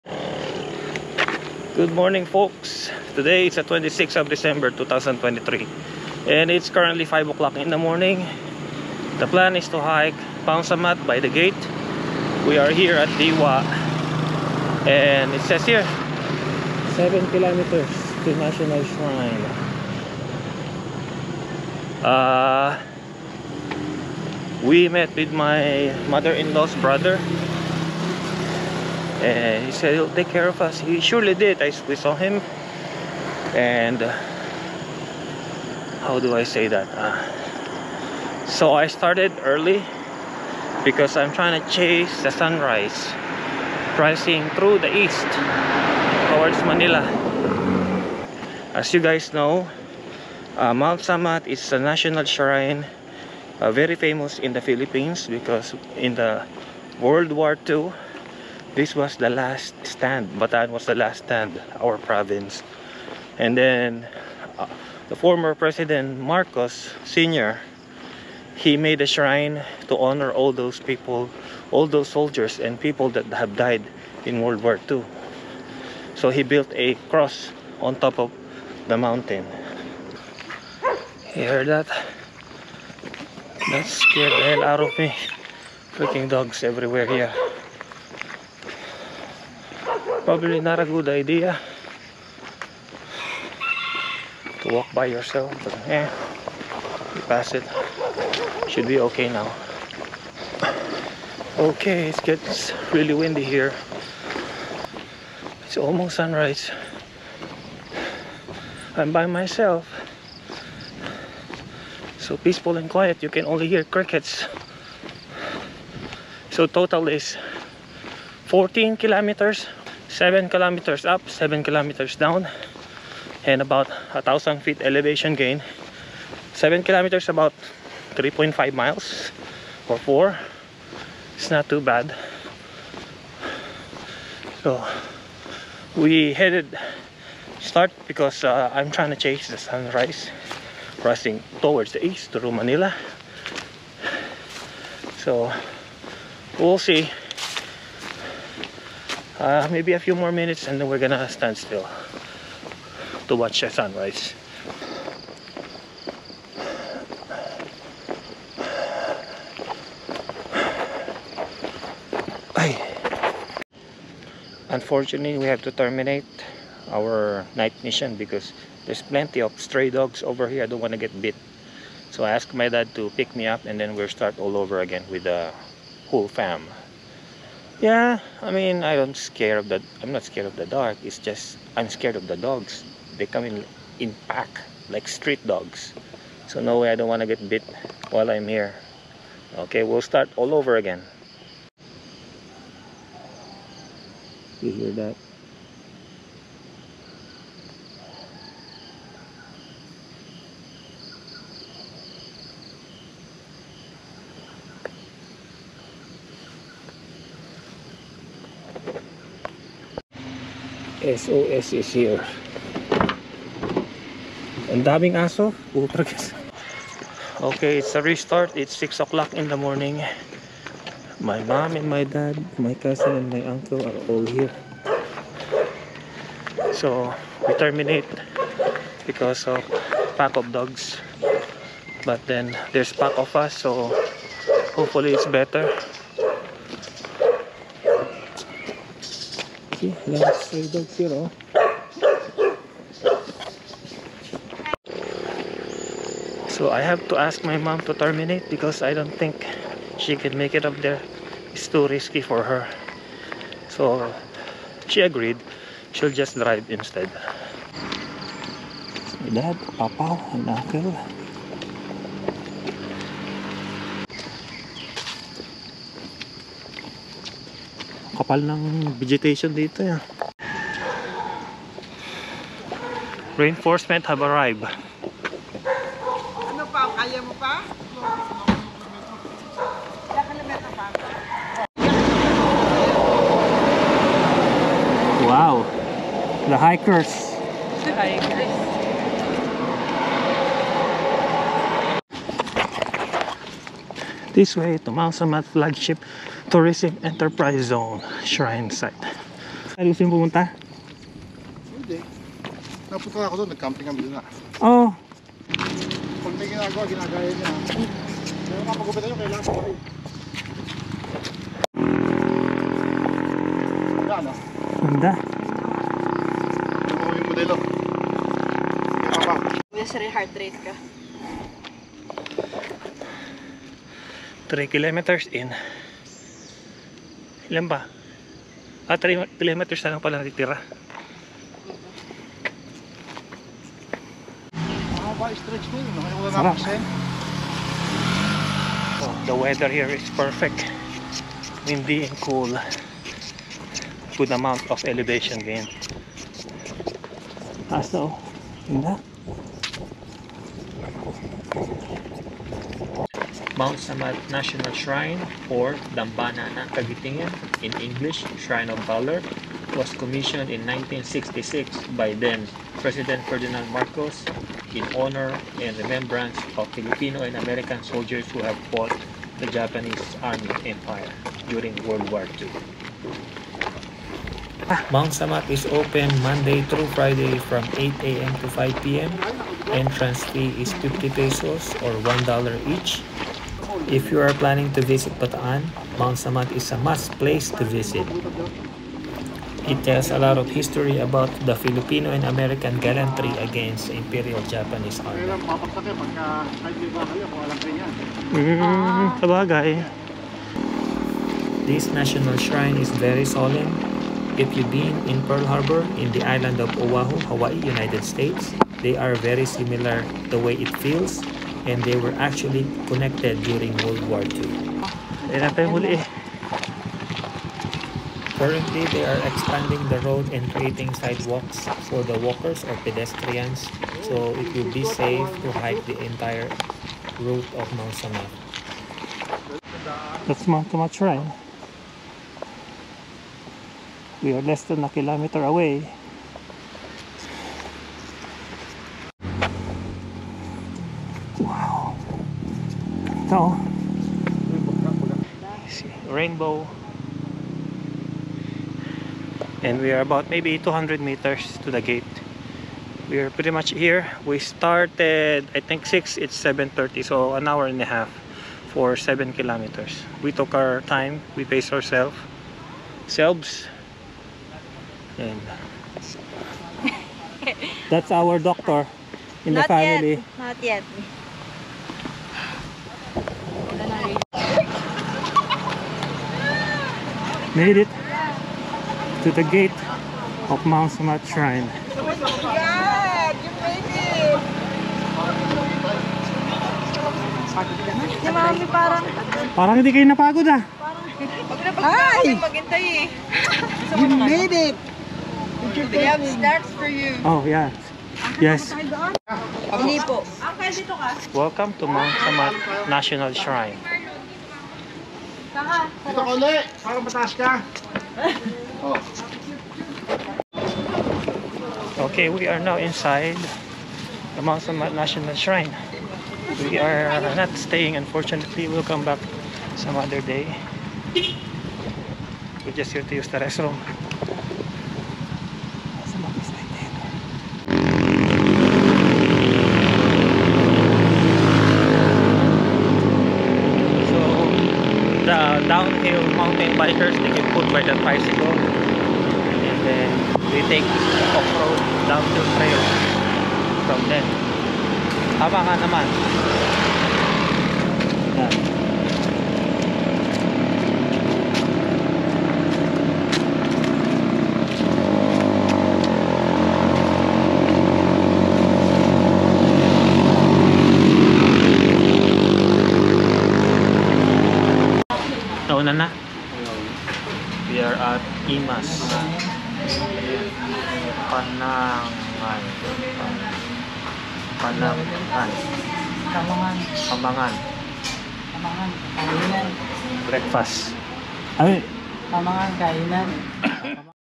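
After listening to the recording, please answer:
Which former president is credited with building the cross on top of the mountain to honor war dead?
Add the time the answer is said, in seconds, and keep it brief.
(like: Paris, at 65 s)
Marcos senior, at 66 s.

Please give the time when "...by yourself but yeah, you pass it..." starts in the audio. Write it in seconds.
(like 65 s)
94 s.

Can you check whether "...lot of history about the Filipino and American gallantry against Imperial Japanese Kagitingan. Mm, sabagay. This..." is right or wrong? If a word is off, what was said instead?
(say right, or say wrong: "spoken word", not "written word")
wrong: "Army", not "Kagitingan".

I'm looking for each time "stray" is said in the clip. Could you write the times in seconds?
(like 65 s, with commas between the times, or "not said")
169 s, 240 s.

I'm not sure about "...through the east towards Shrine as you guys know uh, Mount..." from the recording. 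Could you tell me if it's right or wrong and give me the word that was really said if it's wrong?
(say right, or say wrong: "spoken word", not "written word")
wrong: "Manila", not "Shrine".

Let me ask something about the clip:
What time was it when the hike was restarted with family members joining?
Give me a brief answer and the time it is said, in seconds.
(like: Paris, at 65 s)
6 o'clock, at 218 s.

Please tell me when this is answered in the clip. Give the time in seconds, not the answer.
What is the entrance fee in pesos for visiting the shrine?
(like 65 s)
380 s.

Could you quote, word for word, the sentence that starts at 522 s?
We're just here to use the restroom.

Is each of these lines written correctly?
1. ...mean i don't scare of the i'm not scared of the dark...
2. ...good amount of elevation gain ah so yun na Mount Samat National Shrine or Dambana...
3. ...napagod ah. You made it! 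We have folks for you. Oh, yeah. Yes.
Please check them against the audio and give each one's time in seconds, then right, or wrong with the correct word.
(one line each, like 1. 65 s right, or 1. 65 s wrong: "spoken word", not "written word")
1. 178 s right
2. 344 s right
3. 490 s wrong: "snacks", not "folks".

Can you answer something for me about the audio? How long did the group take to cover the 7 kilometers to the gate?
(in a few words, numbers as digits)
an hour and a half.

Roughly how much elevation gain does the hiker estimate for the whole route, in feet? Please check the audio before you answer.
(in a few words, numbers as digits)
1000 feet.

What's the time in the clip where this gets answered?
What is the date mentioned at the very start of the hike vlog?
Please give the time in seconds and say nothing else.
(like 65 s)
3 s.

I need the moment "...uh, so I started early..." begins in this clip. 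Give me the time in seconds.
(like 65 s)
36 s.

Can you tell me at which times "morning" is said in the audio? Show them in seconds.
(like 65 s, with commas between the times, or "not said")
1 s, 7 s, 219 s.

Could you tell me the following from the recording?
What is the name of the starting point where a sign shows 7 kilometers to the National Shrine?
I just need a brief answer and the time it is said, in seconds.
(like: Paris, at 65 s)
Diwa, at 13 s.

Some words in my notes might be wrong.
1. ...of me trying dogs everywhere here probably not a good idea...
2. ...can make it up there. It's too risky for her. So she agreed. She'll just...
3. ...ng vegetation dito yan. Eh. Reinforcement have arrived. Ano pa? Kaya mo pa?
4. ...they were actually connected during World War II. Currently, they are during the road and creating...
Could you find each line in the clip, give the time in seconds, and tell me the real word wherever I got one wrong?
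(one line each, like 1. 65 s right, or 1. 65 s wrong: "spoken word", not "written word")
1. 84 s wrong: "freaking", not "trying"
2. 250 s right
3. 268 s right
4. 411 s wrong: "expanding", not "during".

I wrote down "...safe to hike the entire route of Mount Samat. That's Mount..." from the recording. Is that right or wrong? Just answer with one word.
right.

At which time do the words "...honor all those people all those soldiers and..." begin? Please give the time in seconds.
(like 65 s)
69 s.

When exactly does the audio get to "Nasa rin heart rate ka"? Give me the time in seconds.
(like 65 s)
319 s.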